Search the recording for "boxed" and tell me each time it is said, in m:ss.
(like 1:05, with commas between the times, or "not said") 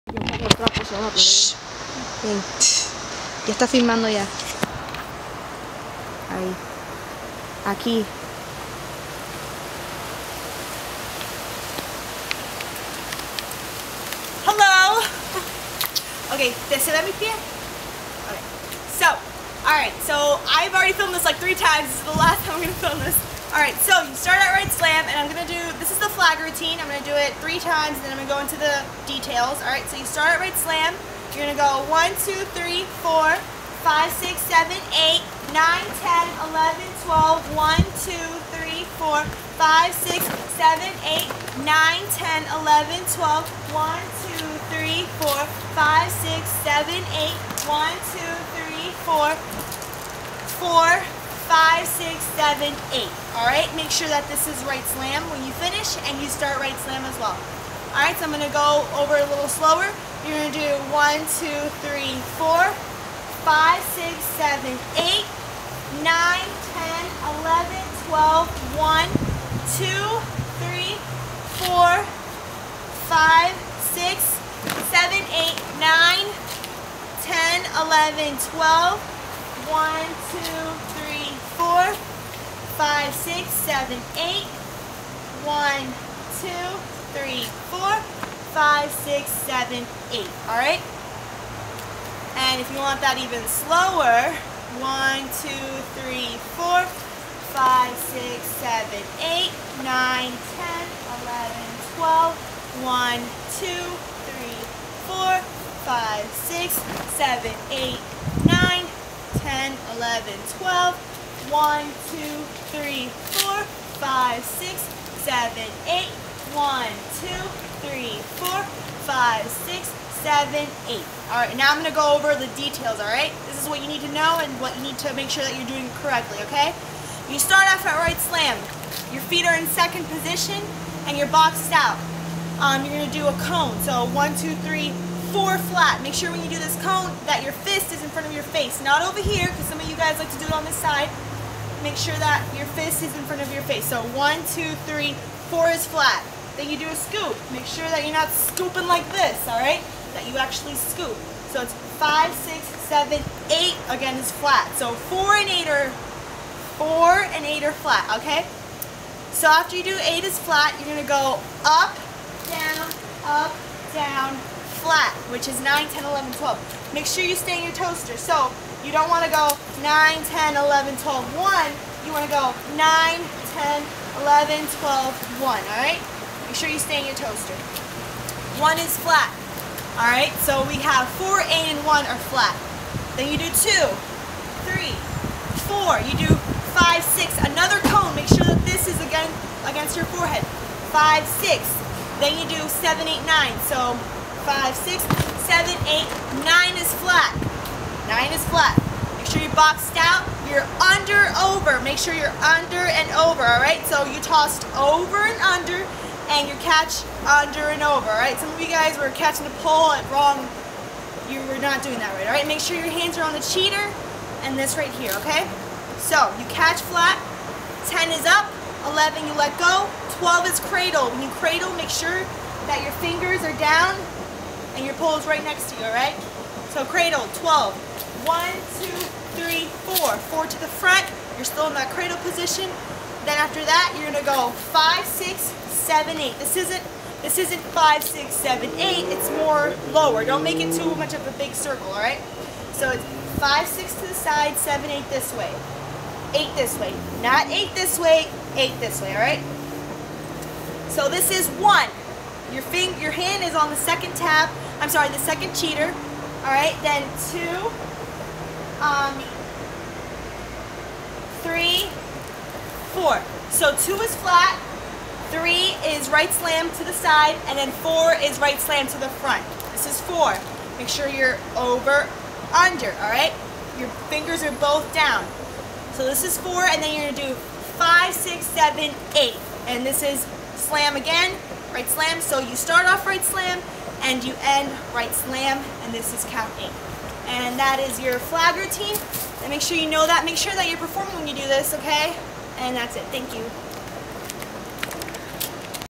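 2:11, 3:19.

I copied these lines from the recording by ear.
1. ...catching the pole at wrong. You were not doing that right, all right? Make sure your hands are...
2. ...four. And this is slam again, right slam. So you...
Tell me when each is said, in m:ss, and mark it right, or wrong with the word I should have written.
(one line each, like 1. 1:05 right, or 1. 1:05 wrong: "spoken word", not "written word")
1. 3:29 right
2. 4:39 wrong: "eight", not "four".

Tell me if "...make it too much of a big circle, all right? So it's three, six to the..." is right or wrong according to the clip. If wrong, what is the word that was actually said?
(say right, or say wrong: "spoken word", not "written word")
wrong: "five", not "three".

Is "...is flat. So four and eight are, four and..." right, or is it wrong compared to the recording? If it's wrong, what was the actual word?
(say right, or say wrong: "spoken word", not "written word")
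right.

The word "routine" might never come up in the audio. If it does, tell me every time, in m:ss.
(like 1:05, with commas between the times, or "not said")
4:48.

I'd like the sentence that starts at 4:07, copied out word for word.
Not eight this way, eight this way, all right?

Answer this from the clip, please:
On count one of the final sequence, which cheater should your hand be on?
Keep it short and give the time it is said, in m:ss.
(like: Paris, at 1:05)
The second cheater, at 4:15.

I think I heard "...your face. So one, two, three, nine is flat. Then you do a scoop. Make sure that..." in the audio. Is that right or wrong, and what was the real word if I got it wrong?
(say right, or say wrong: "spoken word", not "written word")
wrong: "four", not "nine".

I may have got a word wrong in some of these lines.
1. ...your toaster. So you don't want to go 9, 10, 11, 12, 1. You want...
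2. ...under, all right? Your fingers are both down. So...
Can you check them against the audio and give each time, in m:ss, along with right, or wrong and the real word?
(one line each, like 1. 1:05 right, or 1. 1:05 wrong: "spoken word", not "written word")
1. 2:47 right
2. 4:32 right.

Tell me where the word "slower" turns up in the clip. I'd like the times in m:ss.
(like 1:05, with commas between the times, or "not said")
0:59, 1:33.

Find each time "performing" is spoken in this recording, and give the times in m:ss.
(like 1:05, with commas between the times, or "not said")
4:50.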